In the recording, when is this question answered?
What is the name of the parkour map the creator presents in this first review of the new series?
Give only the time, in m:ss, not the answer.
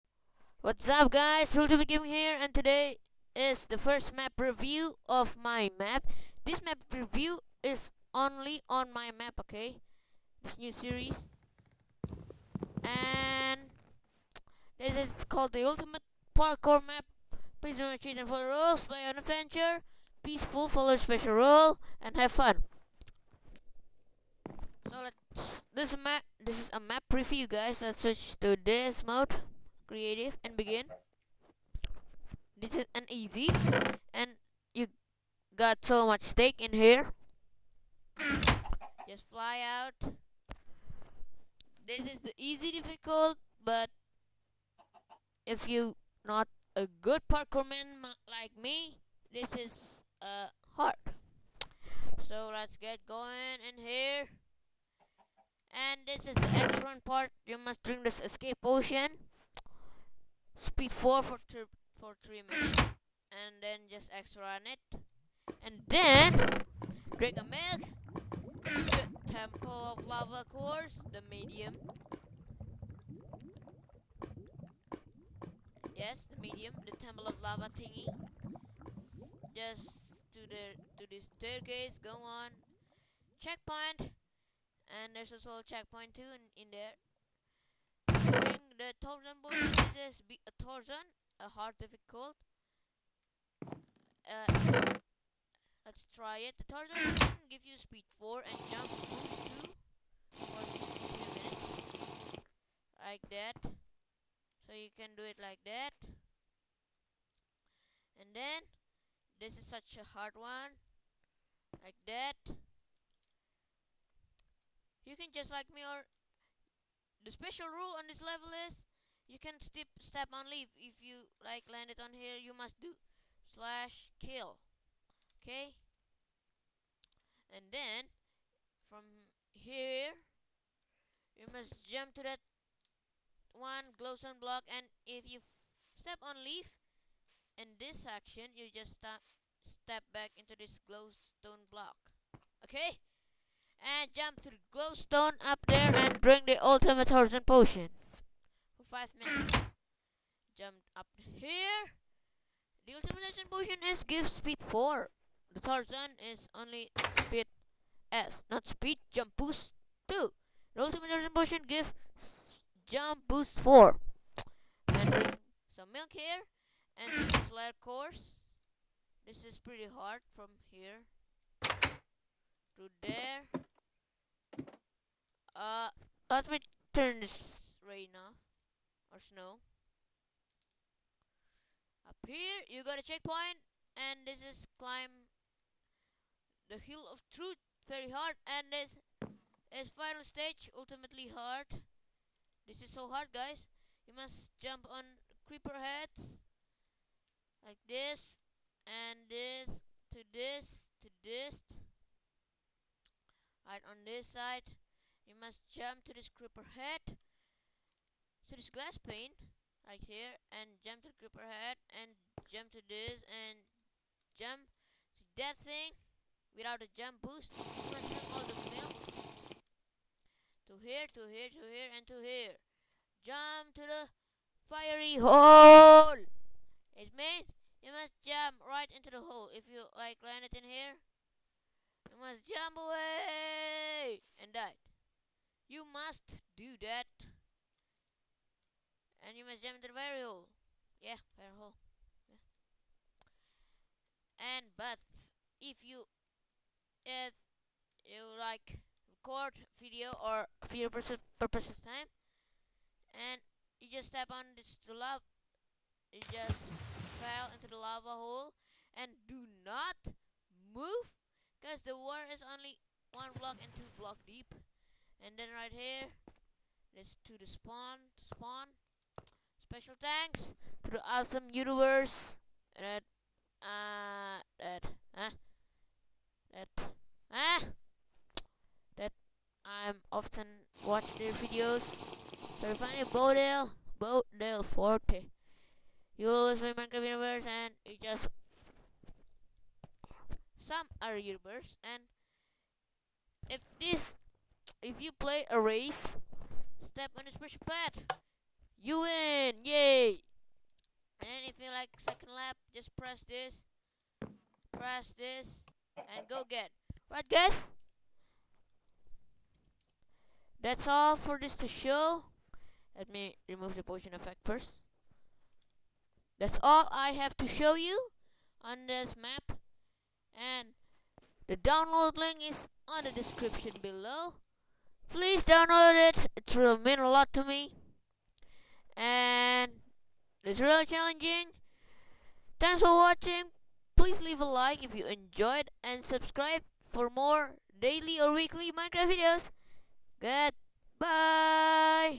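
0:15.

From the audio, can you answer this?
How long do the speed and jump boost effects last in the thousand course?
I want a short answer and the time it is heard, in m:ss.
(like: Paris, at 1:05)
2 minutes, at 1:41.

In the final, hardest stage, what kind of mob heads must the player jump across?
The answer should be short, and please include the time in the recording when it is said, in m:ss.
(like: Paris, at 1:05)
creeper heads, at 3:15.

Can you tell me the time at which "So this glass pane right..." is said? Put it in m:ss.
3:28.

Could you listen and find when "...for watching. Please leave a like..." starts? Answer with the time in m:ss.
5:32.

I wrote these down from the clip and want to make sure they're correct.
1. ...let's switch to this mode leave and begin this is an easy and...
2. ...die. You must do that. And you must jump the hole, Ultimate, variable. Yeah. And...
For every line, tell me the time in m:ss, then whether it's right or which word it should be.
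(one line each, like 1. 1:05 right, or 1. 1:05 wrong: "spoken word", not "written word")
1. 0:27 wrong: "creative", not "leave"
2. 3:54 wrong: "Yeah", not "Ultimate".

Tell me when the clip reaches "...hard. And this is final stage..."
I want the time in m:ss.
3:08.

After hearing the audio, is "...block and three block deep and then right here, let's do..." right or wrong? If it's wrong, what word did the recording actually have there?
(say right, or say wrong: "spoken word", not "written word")
wrong: "two", not "three".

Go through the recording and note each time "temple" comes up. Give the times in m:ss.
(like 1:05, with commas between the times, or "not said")
1:09, 1:16.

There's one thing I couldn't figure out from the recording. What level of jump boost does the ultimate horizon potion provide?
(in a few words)
jump boost 4.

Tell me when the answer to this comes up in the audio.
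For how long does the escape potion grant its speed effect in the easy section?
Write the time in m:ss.
1:02.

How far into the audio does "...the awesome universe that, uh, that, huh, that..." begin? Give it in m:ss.
4:30.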